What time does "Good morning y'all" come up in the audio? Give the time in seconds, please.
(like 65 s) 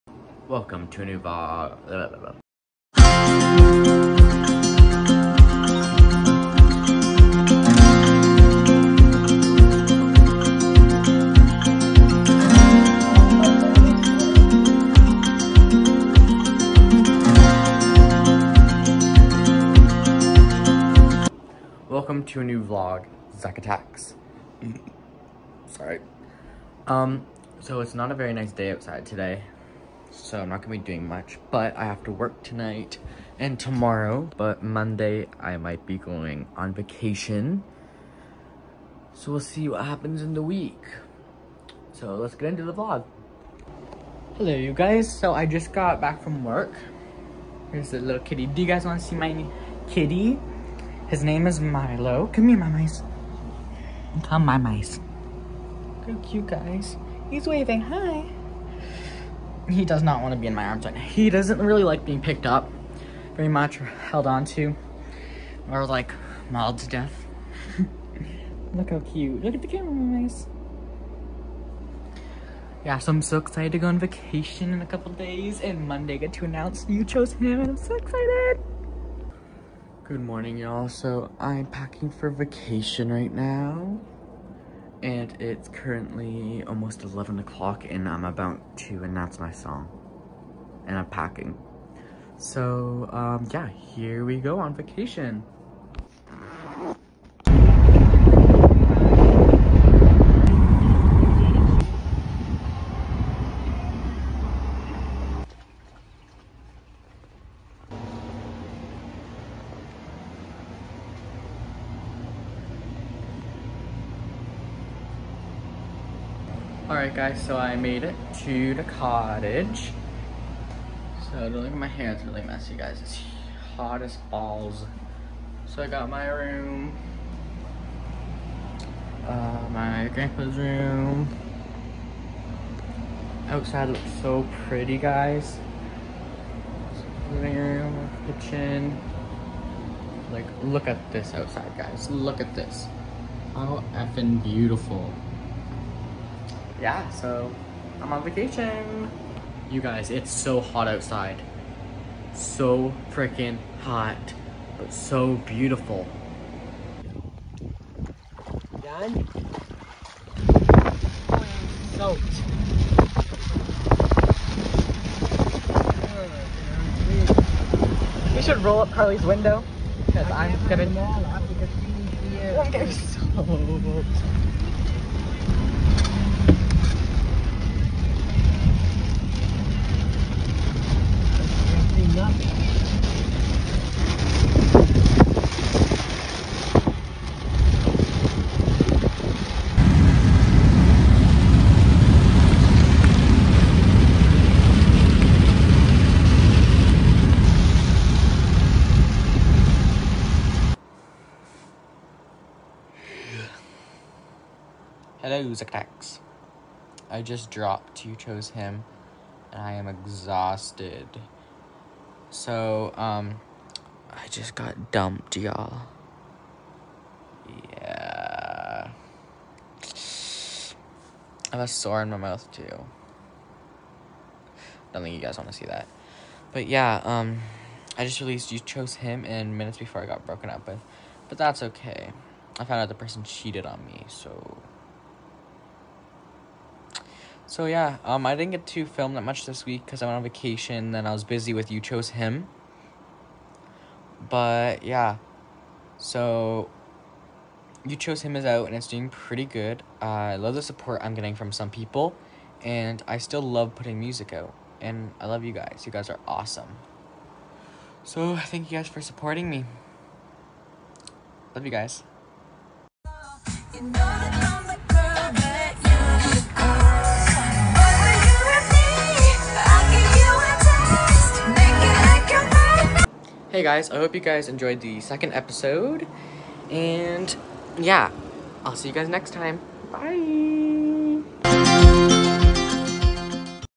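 80 s.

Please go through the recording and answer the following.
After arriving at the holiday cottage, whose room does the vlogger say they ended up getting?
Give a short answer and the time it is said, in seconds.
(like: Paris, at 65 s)
grandpa's room, at 129 s.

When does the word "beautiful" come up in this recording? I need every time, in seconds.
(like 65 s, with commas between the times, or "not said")
144 s, 155 s.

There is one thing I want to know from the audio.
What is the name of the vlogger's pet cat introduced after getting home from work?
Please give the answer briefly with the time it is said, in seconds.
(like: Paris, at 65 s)
Milo, at 51 s.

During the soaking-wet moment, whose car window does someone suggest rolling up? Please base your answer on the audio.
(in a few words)
Carly's.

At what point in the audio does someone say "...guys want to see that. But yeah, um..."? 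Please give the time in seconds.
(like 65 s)
225 s.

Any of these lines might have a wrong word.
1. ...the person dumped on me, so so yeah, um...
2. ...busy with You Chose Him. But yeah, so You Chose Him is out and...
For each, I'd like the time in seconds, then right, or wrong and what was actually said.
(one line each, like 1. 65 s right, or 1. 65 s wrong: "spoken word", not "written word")
1. 232 s wrong: "cheated", not "dumped"
2. 241 s right.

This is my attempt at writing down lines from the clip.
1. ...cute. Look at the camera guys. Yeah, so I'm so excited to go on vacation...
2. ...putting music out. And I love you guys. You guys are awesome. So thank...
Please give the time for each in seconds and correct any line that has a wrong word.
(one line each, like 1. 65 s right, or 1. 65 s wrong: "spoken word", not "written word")
1. 68 s right
2. 253 s right.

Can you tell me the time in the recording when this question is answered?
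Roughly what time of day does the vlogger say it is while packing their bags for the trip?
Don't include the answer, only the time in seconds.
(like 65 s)
86 s.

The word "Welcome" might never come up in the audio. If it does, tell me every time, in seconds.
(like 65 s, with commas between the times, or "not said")
0 s, 21 s.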